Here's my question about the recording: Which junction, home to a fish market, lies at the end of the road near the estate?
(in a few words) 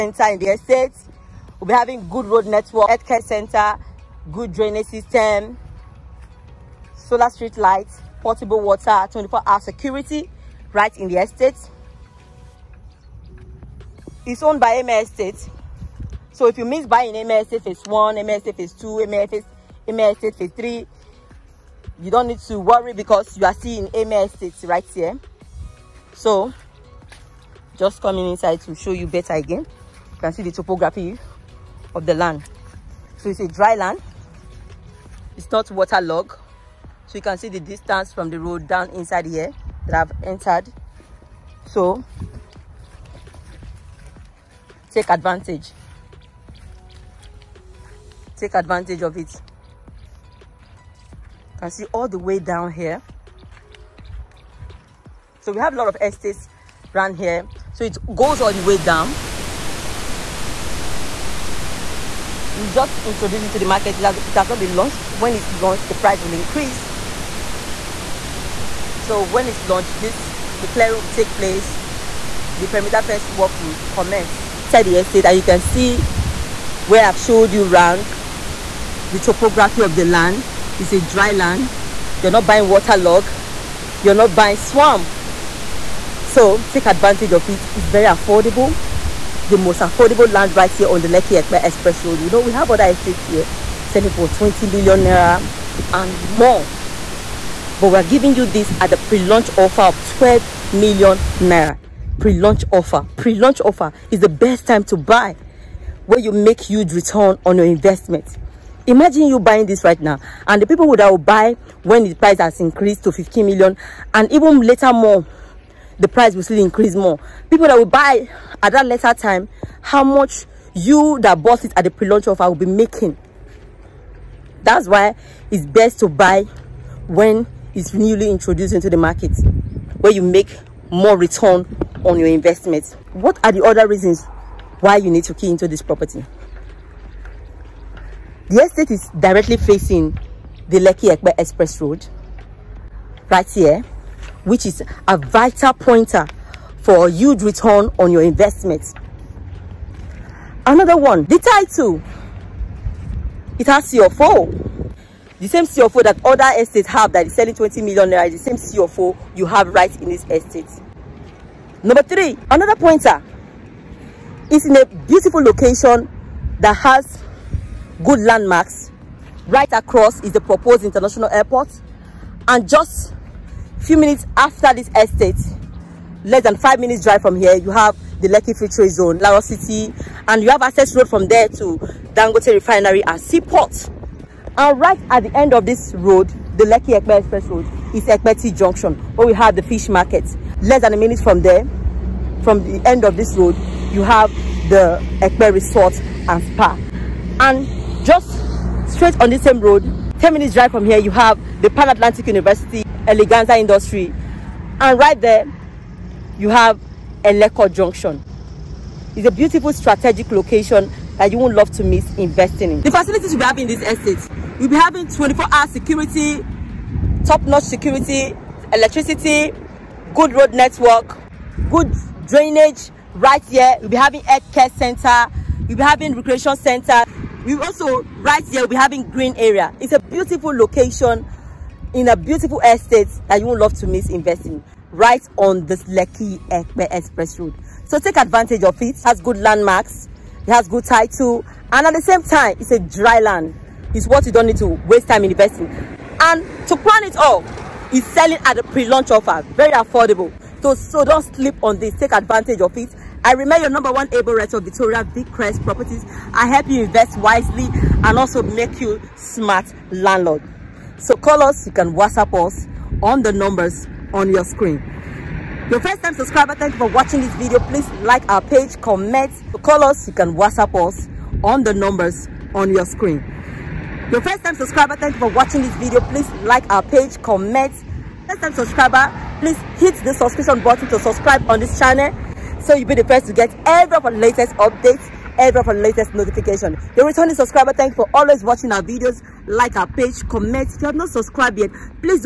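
Ekpeti Junction.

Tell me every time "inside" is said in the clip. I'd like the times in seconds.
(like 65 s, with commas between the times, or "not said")
28 s, 38 s, 74 s.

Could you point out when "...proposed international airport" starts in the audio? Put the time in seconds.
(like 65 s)
170 s.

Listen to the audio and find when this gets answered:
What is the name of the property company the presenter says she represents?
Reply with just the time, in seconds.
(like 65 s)
255 s.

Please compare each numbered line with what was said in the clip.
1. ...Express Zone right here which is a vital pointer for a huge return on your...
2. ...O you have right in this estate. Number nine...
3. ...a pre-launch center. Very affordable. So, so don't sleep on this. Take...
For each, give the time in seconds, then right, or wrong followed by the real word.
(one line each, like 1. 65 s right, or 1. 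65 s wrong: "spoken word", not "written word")
1. 141 s wrong: "Road", not "Zone"
2. 158 s wrong: "three", not "nine"
3. 248 s wrong: "offer", not "center".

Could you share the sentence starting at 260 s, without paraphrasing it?
So call us, you can WhatsApp us on the numbers on your screen.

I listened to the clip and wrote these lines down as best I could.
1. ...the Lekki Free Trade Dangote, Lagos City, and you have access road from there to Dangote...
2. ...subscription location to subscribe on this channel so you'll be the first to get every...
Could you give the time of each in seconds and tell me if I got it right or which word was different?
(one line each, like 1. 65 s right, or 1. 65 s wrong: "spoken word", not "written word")
1. 178 s wrong: "Zone", not "Dangote"
2. 280 s wrong: "button", not "location".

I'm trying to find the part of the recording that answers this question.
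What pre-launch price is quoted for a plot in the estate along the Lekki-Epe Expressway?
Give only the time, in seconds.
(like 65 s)
100 s.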